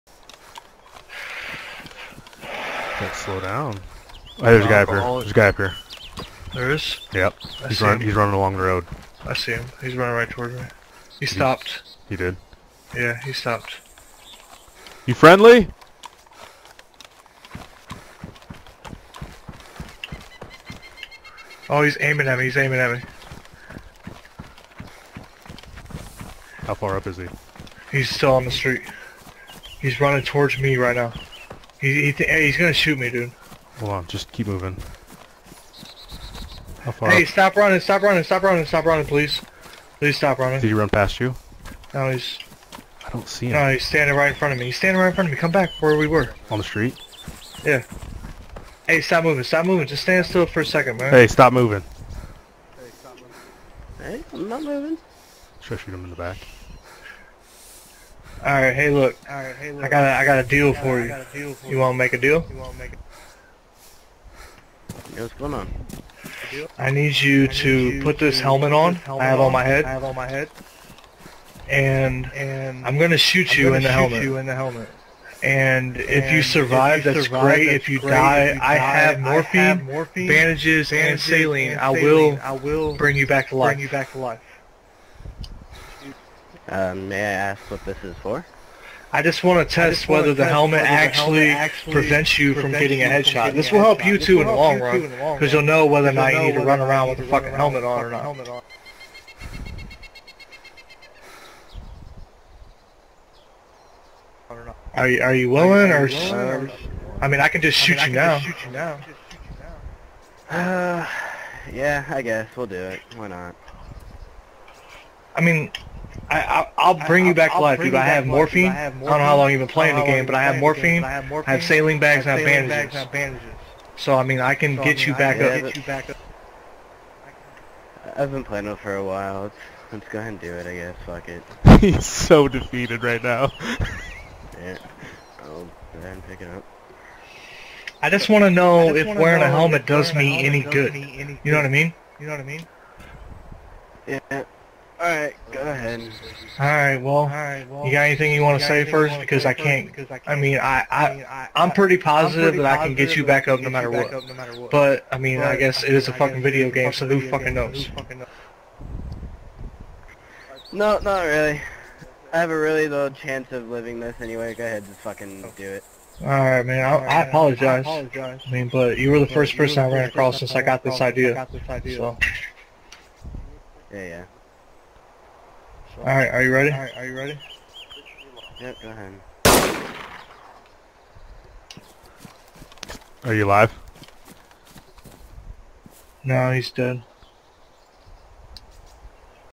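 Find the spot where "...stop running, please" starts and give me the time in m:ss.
0:38.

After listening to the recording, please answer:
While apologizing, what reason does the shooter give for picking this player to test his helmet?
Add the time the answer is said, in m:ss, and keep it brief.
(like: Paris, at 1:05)
first person, at 2:49.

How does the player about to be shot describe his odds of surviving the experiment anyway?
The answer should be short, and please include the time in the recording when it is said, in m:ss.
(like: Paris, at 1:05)
really low chance, at 2:42.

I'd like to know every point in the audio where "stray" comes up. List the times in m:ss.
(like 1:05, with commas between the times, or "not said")
not said.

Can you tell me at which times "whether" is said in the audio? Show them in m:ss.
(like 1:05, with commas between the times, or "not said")
1:30, 1:35.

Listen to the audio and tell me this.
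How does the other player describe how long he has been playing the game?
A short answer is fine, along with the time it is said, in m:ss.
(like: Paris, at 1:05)
a while, at 2:08.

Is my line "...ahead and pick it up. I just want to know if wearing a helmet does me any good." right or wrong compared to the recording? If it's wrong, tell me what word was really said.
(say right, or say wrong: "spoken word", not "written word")
right.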